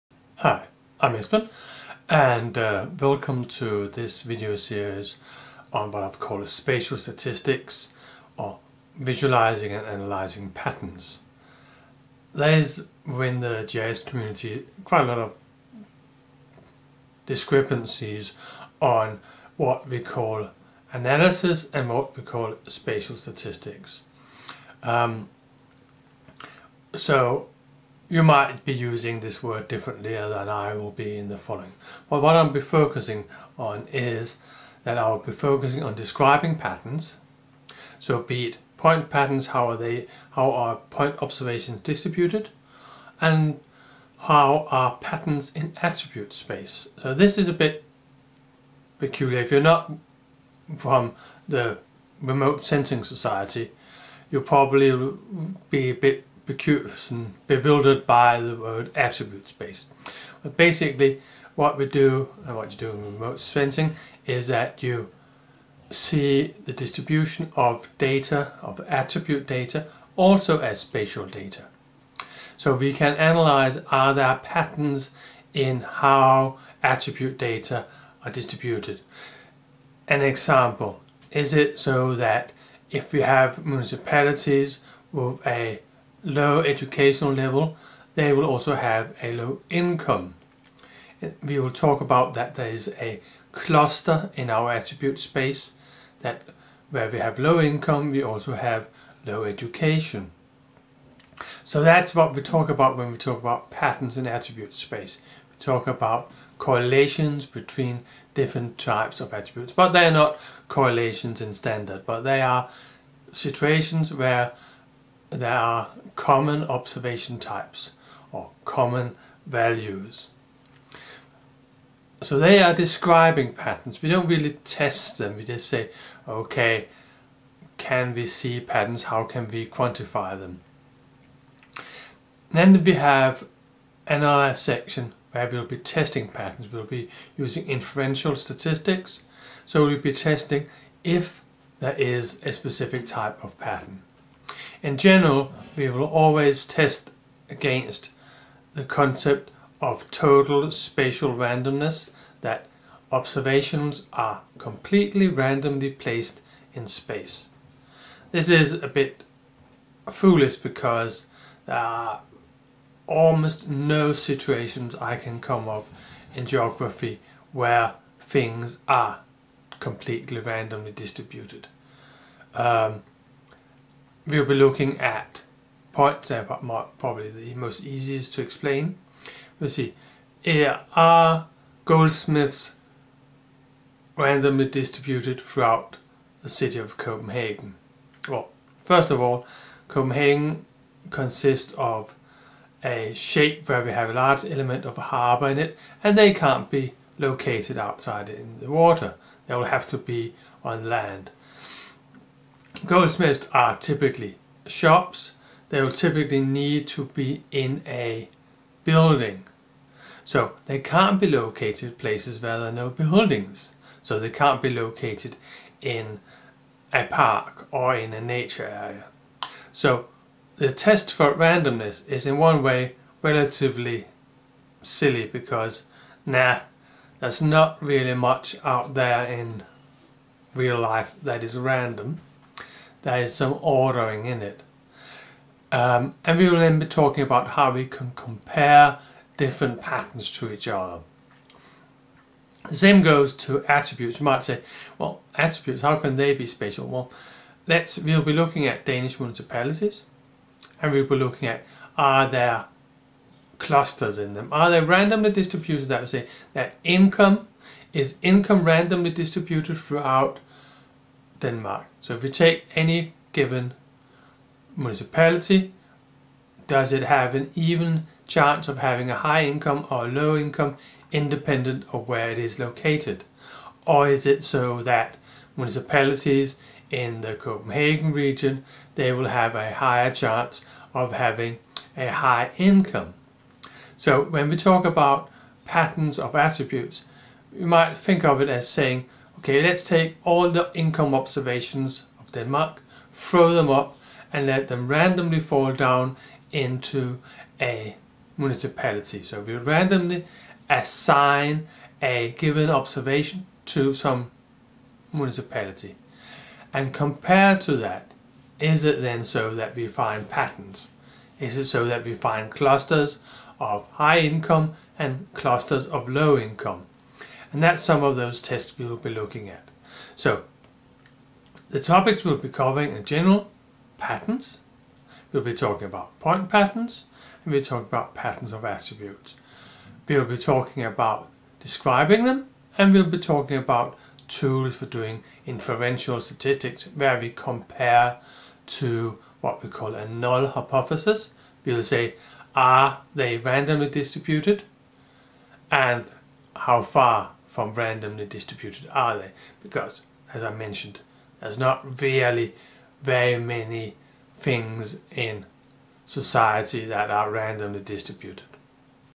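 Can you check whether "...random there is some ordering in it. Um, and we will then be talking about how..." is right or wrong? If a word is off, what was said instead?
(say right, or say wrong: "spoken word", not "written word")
right.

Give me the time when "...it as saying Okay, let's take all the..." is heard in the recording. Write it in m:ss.
4:48.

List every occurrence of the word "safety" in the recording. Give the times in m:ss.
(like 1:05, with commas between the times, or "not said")
not said.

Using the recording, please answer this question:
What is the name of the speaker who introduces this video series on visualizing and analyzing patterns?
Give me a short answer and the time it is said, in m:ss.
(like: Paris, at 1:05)
Espen, at 0:01.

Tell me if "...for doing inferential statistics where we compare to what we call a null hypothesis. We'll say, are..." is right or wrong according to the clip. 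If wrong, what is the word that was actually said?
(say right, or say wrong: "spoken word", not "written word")
right.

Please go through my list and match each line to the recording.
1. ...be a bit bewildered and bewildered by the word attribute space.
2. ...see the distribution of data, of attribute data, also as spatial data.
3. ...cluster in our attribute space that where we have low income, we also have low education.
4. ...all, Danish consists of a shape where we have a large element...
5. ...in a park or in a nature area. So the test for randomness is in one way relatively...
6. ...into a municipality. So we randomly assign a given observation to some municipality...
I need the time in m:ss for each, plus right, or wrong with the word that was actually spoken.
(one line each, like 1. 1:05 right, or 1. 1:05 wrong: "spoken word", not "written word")
1. 0:55 wrong: "confused", not "bewildered"
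2. 1:05 right
3. 1:33 right
4. 3:09 wrong: "Copenhagen", not "Danish"
5. 3:35 right
6. 4:56 right.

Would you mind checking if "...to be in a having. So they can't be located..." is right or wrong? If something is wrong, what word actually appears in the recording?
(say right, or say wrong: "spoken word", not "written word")
wrong: "building", not "having".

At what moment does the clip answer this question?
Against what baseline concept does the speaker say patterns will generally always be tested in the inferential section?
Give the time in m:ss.
2:30.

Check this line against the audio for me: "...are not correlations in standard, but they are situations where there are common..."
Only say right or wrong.
right.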